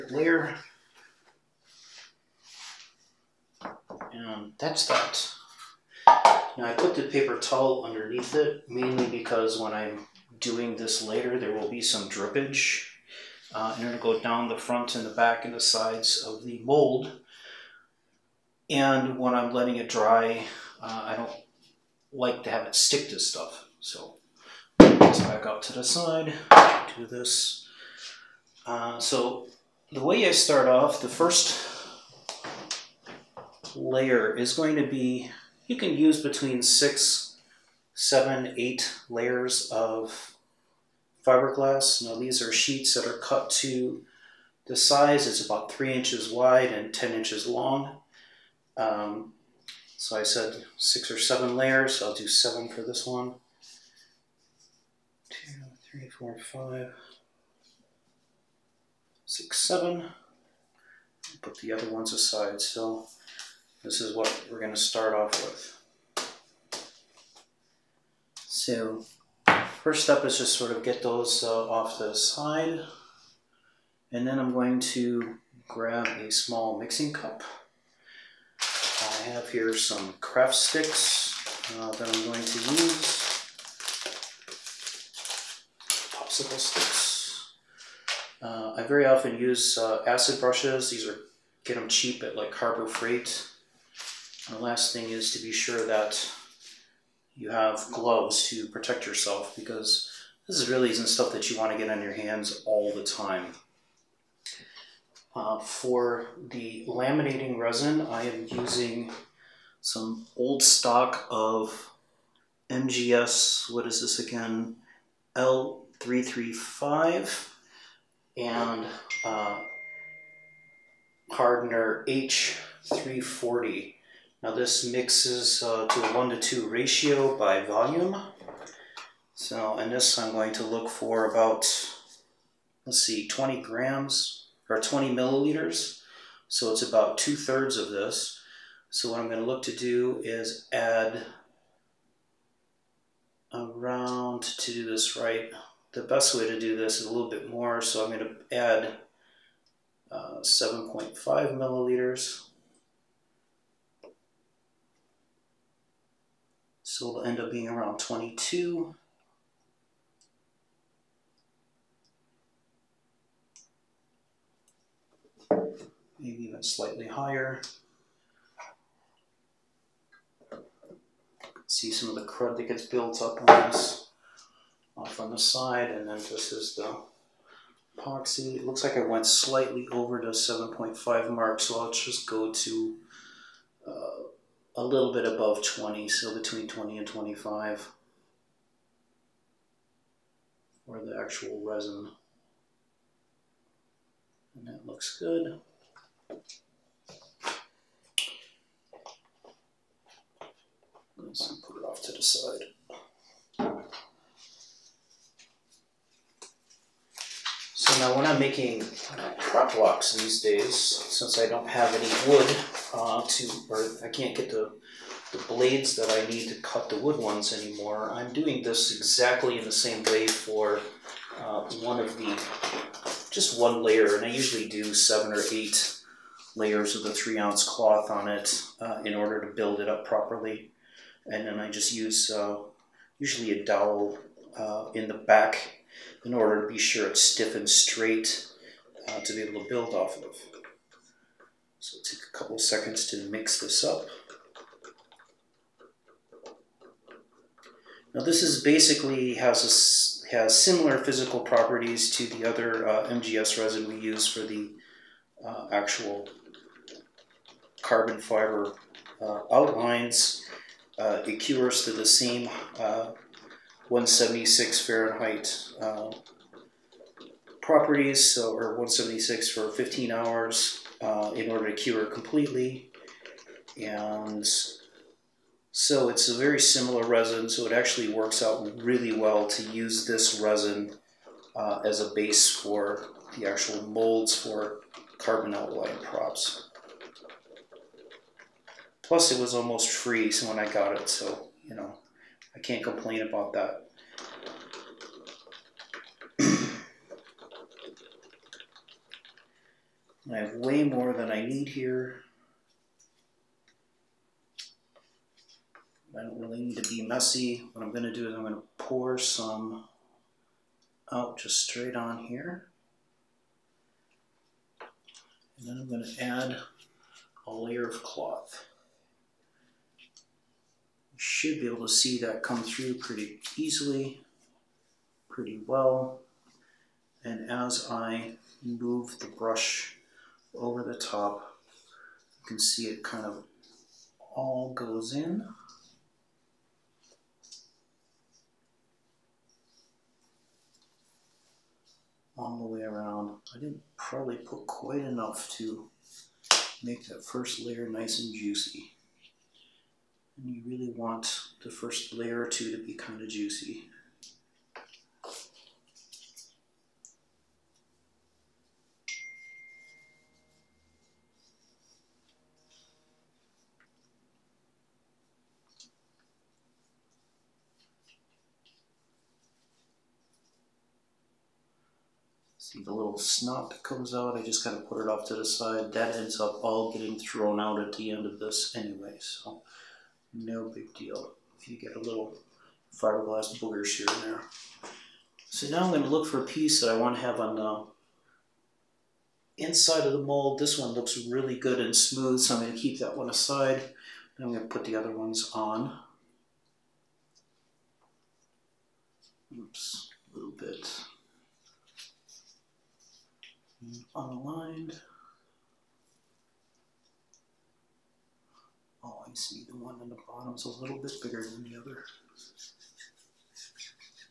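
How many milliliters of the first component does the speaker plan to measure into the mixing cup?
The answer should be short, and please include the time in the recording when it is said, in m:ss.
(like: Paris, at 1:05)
7.5 milliliters, at 2:30.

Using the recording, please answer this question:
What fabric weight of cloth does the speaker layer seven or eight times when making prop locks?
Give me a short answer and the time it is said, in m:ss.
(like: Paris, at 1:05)
3 ounce, at 3:47.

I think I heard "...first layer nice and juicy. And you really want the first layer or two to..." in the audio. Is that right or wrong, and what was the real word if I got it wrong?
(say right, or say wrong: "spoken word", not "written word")
right.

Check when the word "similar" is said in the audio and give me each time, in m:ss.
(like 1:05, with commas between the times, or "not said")
4:10, 4:36.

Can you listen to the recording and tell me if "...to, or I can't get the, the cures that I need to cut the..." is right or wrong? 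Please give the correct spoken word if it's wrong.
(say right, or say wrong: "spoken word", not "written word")
wrong: "blades", not "cures".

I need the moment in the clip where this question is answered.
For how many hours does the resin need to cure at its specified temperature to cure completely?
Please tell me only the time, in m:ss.
4:29.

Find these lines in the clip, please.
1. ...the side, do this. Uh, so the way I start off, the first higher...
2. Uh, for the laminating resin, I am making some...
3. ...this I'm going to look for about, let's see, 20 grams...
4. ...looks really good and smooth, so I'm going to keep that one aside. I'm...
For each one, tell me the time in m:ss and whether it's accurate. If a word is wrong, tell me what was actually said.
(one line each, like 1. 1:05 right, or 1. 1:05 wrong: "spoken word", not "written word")
1. 0:25 wrong: "layer", not "higher"
2. 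1:45 wrong: "using", not "making"
3. 2:09 right
4. 6:30 right.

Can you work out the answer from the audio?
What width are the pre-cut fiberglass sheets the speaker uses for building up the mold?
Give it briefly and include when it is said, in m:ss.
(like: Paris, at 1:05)
3 inches, at 0:45.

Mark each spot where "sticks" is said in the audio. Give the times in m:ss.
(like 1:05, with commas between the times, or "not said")
0:22, 1:20, 1:26.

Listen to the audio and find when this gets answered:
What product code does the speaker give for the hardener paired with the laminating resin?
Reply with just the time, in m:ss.
2:02.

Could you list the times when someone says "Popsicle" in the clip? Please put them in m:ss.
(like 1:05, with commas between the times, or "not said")
1:26.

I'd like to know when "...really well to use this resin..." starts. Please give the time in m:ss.
4:38.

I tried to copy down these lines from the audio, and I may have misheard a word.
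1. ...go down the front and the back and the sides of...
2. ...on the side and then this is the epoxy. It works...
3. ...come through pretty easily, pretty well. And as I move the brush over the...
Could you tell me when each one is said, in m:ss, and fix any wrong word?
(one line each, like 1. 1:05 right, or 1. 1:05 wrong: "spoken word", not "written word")
1. 0:14 right
2. 2:55 wrong: "looks", not "works"
3. 5:22 right.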